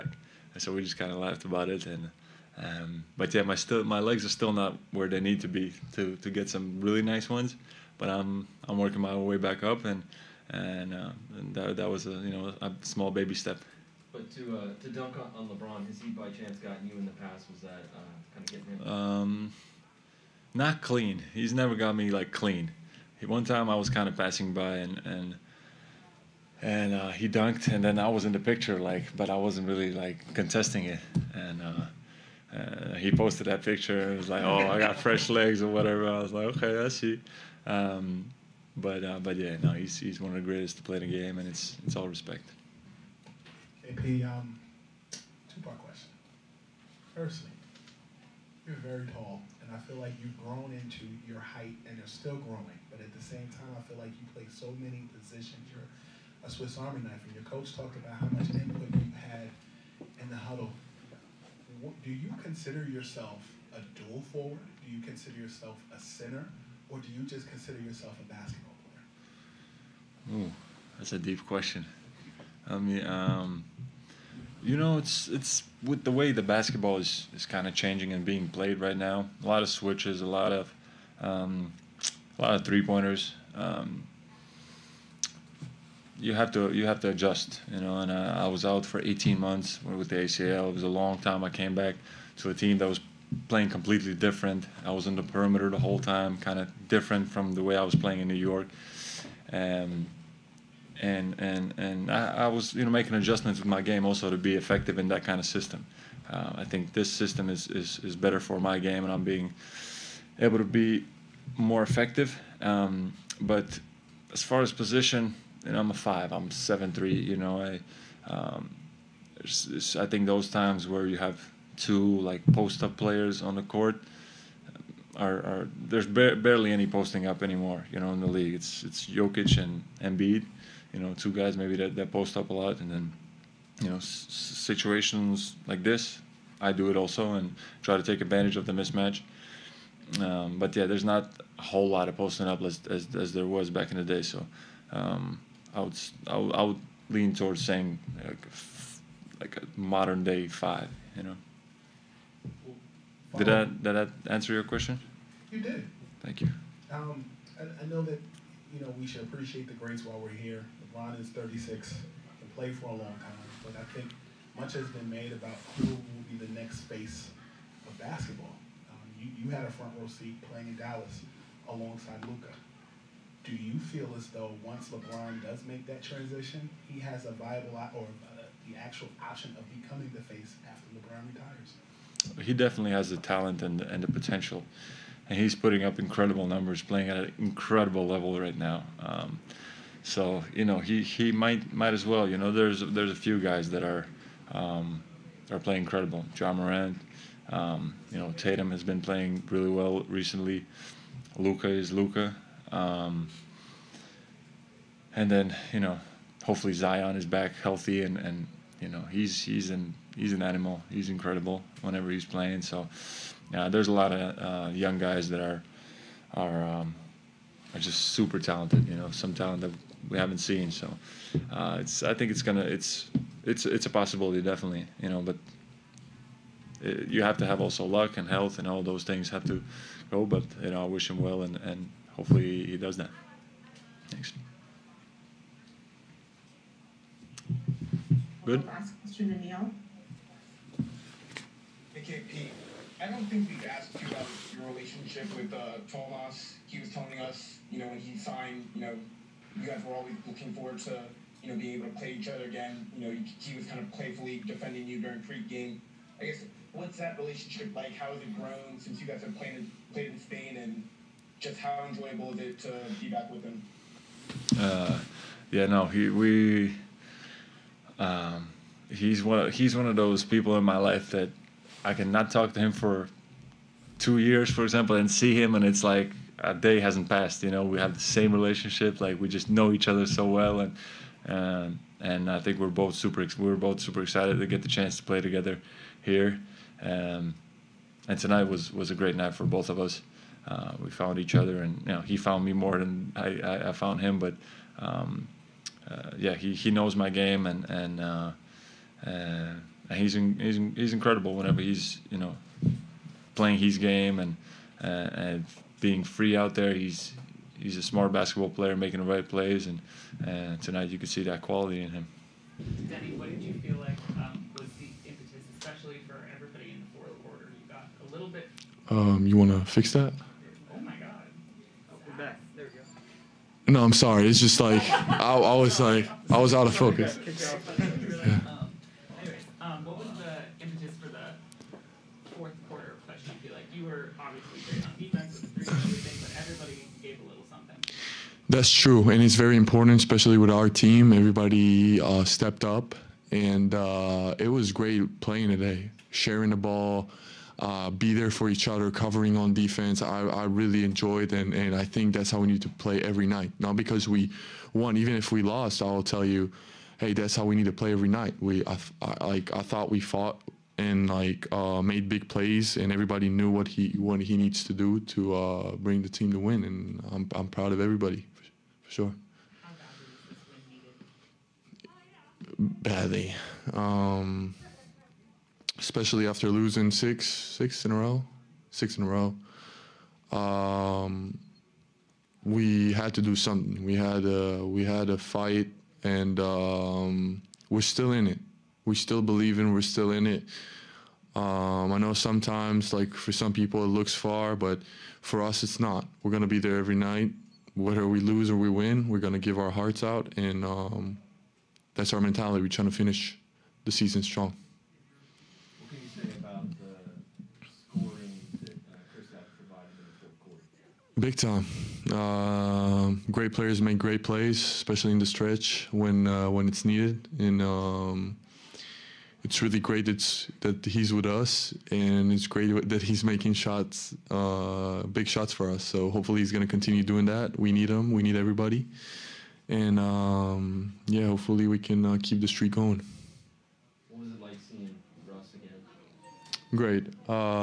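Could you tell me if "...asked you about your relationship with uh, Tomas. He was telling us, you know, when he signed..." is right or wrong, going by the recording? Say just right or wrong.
right.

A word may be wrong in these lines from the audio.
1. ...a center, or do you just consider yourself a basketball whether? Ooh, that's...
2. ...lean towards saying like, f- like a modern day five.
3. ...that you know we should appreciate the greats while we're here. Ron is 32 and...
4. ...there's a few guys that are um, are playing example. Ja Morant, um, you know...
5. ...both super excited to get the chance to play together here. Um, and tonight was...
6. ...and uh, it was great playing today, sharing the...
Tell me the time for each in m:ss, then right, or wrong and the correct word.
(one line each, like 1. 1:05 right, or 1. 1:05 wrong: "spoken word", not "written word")
1. 1:05 wrong: "player", not "whether"
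2. 2:27 right
3. 2:38 wrong: "36", not "32"
4. 3:12 wrong: "incredible", not "example"
5. 4:43 right
6. 5:43 right.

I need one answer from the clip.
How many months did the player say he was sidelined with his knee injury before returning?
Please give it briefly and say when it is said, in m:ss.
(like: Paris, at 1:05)
18, at 1:29.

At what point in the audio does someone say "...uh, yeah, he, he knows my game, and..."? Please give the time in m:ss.
4:55.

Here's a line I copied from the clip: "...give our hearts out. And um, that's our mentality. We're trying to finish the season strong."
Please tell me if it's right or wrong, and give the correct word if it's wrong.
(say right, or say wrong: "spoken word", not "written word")
right.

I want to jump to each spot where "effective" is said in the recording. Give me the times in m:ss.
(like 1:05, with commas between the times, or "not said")
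1:44, 1:51.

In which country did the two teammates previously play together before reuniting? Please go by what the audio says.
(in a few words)
Spain.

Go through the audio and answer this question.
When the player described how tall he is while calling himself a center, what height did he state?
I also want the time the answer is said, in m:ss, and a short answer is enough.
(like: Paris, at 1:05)
7'3", at 1:56.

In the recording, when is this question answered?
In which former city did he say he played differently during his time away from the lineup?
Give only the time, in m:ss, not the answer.
1:38.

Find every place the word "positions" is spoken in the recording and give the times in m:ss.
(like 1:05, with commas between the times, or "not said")
0:55, 1:54.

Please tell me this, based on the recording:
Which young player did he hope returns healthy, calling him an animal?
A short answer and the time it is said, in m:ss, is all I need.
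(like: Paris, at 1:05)
Zion, at 3:26.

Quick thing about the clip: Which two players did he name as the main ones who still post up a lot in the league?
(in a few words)
Jokic and Embiid.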